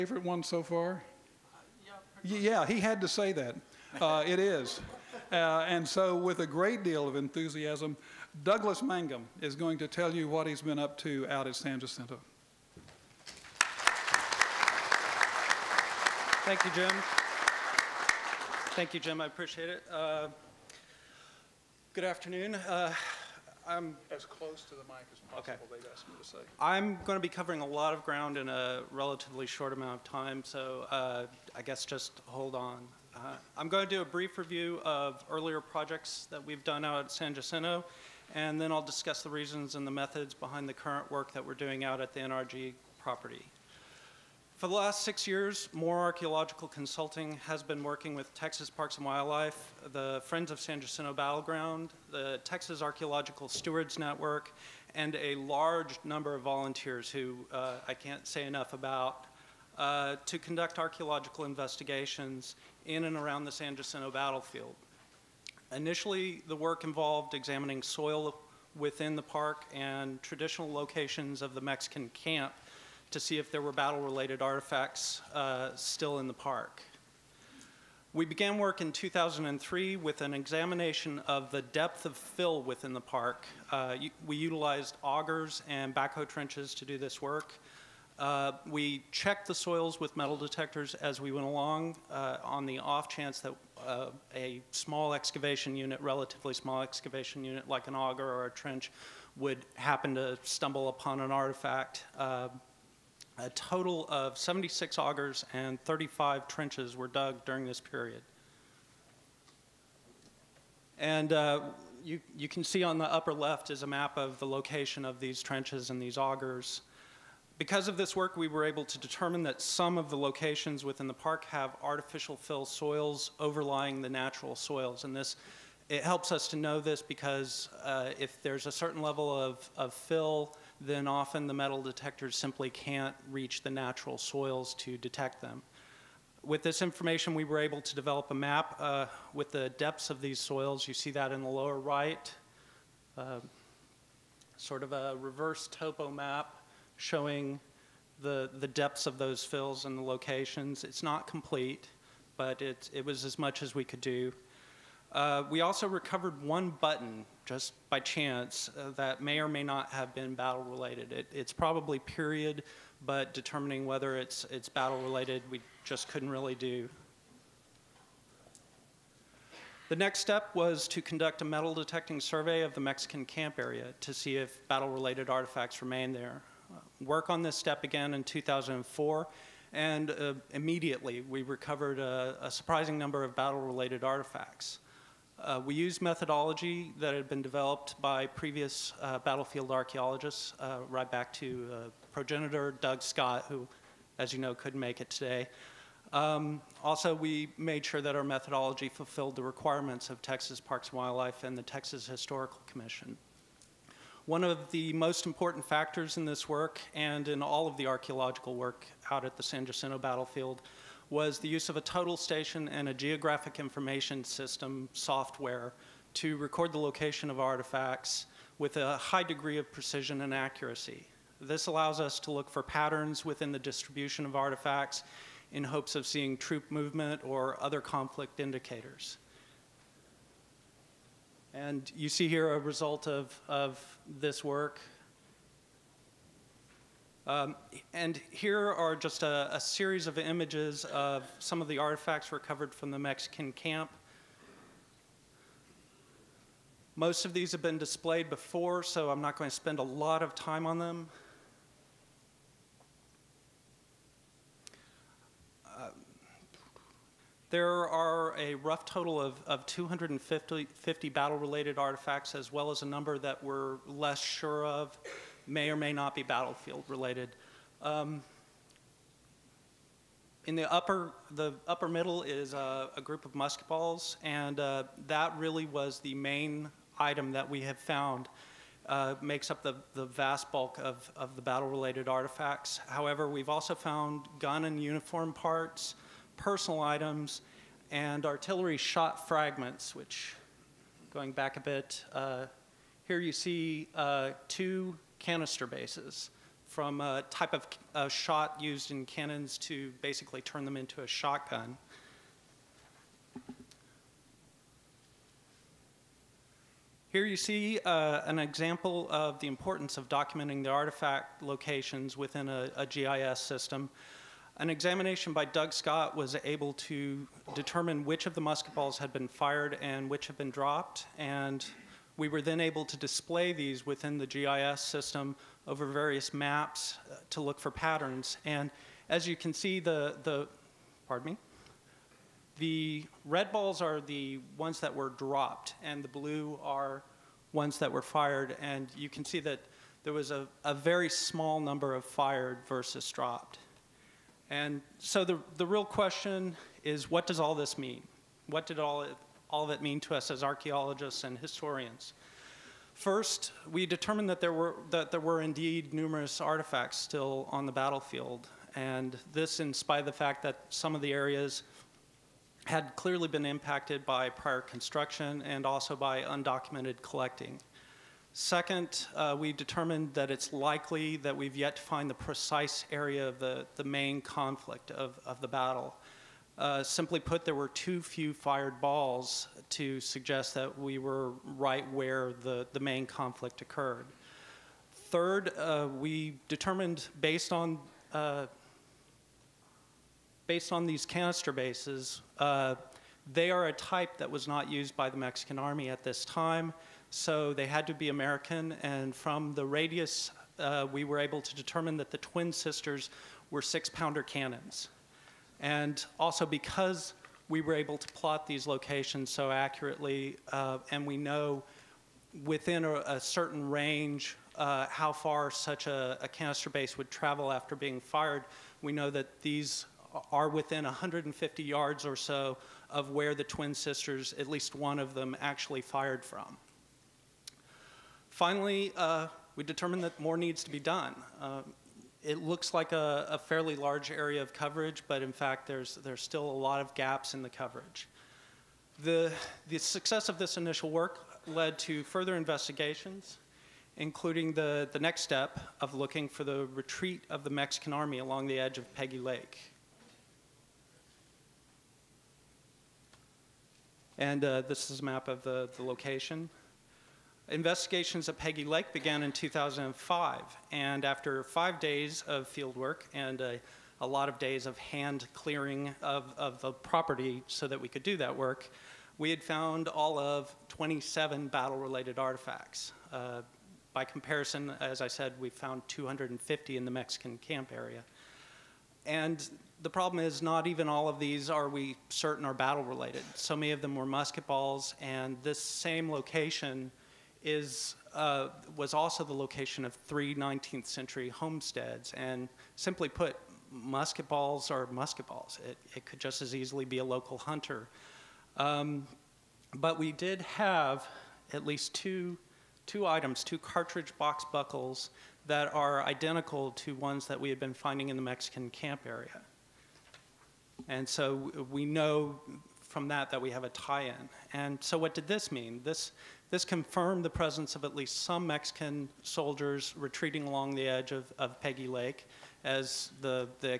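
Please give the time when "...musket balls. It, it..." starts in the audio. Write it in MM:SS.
08:14.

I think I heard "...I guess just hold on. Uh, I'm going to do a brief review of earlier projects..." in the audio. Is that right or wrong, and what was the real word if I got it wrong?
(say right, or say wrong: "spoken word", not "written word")
right.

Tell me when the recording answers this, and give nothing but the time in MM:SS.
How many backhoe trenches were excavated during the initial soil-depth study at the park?
01:45.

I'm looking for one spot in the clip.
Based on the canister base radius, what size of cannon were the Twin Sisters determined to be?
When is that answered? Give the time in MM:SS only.
06:43.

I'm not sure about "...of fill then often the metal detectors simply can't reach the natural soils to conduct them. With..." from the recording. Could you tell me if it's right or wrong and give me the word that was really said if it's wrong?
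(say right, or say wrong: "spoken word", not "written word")
wrong: "detect", not "conduct".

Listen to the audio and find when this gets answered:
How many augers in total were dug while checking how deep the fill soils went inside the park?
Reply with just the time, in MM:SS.
01:44.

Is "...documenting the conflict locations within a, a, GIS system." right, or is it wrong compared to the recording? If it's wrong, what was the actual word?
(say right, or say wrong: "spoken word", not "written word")
wrong: "artifact", not "conflict".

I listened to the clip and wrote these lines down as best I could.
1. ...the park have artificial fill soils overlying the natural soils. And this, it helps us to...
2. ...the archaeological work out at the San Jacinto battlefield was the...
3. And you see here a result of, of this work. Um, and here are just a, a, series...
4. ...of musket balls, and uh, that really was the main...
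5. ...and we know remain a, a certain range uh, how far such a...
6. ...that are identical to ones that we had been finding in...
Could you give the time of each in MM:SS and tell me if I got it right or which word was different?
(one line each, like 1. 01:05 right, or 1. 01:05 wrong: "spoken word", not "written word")
1. 02:01 right
2. 03:27 right
3. 03:51 right
4. 04:33 right
5. 06:50 wrong: "within", not "remain"
6. 08:25 right.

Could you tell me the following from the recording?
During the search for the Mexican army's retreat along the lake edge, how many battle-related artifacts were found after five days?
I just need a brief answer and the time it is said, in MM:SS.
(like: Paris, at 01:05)
27, at 07:50.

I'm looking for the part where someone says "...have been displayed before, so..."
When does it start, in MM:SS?
04:07.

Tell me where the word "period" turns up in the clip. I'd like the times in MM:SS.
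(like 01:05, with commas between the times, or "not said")
01:47, 02:41.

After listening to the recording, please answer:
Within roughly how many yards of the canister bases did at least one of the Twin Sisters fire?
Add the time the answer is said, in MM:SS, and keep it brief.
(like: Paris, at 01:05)
150 yards, at 07:00.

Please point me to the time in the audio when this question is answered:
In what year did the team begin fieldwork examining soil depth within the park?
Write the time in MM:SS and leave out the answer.
01:18.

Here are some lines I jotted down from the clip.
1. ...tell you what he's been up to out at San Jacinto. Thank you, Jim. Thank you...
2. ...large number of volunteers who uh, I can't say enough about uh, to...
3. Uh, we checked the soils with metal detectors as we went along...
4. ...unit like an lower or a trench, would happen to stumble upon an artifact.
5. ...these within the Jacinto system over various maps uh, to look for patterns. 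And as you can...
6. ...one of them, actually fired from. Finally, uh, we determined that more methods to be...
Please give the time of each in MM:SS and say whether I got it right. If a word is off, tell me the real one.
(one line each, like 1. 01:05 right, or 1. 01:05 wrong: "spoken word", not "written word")
1. 00:09 right
2. 00:55 right
3. 01:28 right
4. 01:37 wrong: "auger", not "lower"
5. 05:23 wrong: "GIS", not "Jacinto"
6. 07:04 wrong: "needs", not "methods".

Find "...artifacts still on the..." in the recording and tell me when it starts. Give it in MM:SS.
05:56.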